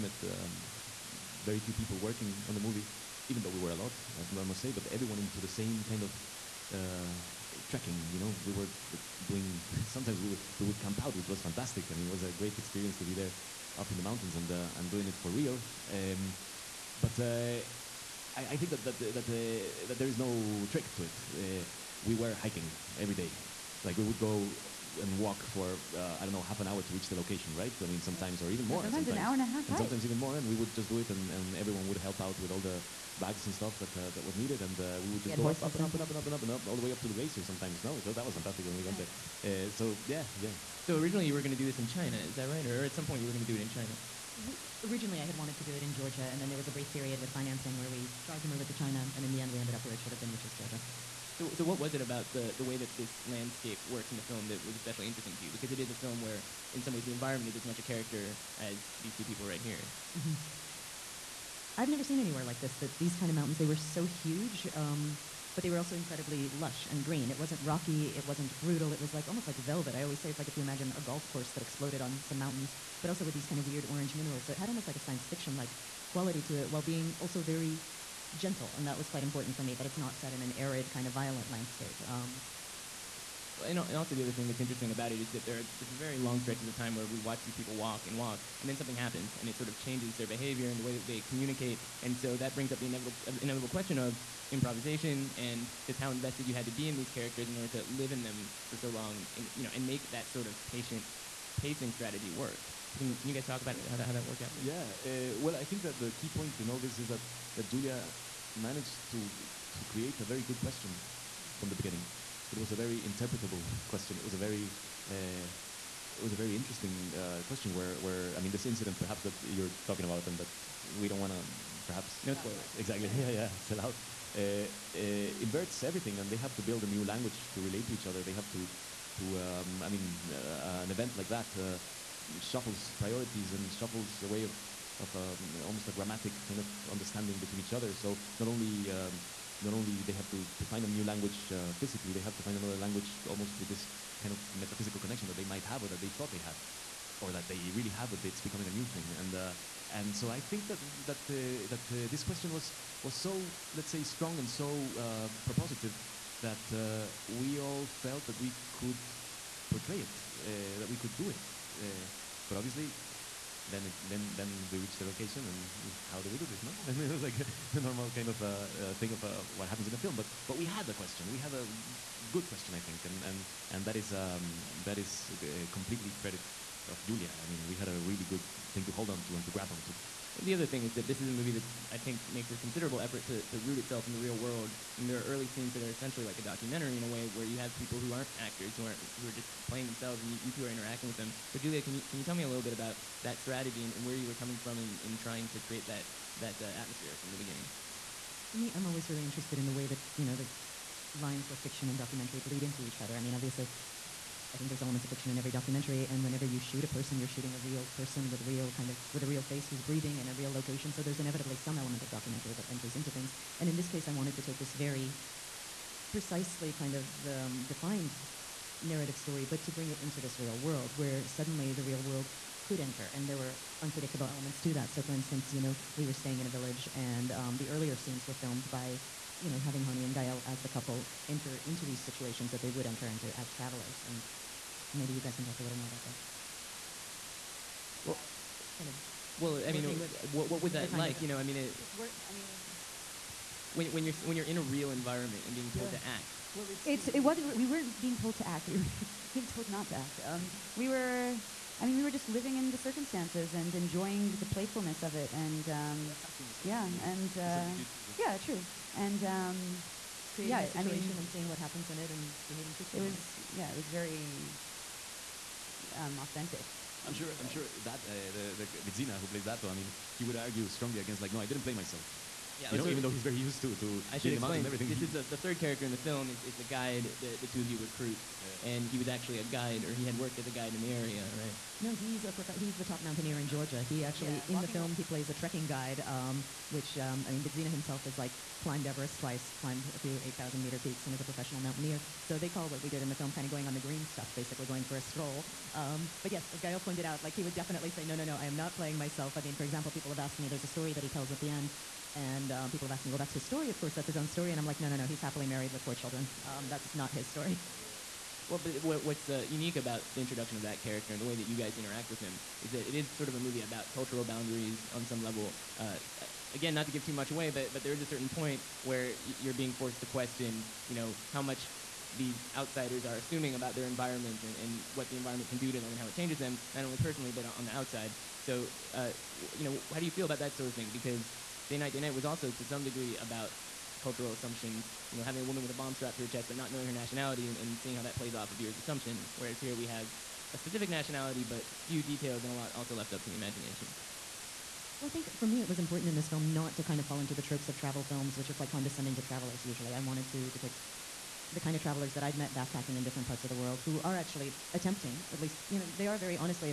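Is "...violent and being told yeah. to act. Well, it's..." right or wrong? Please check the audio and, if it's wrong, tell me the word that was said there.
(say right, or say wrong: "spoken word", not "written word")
wrong: "environment", not "violent".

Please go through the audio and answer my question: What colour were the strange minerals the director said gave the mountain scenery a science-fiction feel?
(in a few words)
orange.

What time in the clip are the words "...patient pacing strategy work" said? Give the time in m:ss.
1:40.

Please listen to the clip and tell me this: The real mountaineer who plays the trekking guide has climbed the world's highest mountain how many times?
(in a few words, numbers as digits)
2.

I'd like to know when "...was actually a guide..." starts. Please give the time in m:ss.
4:38.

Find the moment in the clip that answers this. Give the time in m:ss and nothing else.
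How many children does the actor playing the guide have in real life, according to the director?
5:05.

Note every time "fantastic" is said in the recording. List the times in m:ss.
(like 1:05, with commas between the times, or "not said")
0:11, 0:38.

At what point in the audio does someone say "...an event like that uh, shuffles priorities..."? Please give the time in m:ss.
2:10.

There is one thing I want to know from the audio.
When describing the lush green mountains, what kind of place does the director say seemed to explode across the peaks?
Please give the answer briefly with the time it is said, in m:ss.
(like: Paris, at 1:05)
golf course, at 1:10.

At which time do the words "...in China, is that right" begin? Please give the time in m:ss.
0:41.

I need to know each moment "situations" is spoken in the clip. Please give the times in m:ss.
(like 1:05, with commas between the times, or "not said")
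3:51, 4:20.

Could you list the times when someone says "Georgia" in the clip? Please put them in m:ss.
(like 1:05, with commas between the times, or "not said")
0:45, 0:50, 4:43.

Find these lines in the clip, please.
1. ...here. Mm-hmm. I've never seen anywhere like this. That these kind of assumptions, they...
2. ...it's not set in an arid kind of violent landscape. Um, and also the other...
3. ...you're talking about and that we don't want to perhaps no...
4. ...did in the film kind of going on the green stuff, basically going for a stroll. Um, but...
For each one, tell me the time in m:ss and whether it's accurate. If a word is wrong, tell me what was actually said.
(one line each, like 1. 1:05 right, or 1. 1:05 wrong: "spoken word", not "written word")
1. 0:59 wrong: "mountains", not "assumptions"
2. 1:19 right
3. 1:59 right
4. 4:52 right.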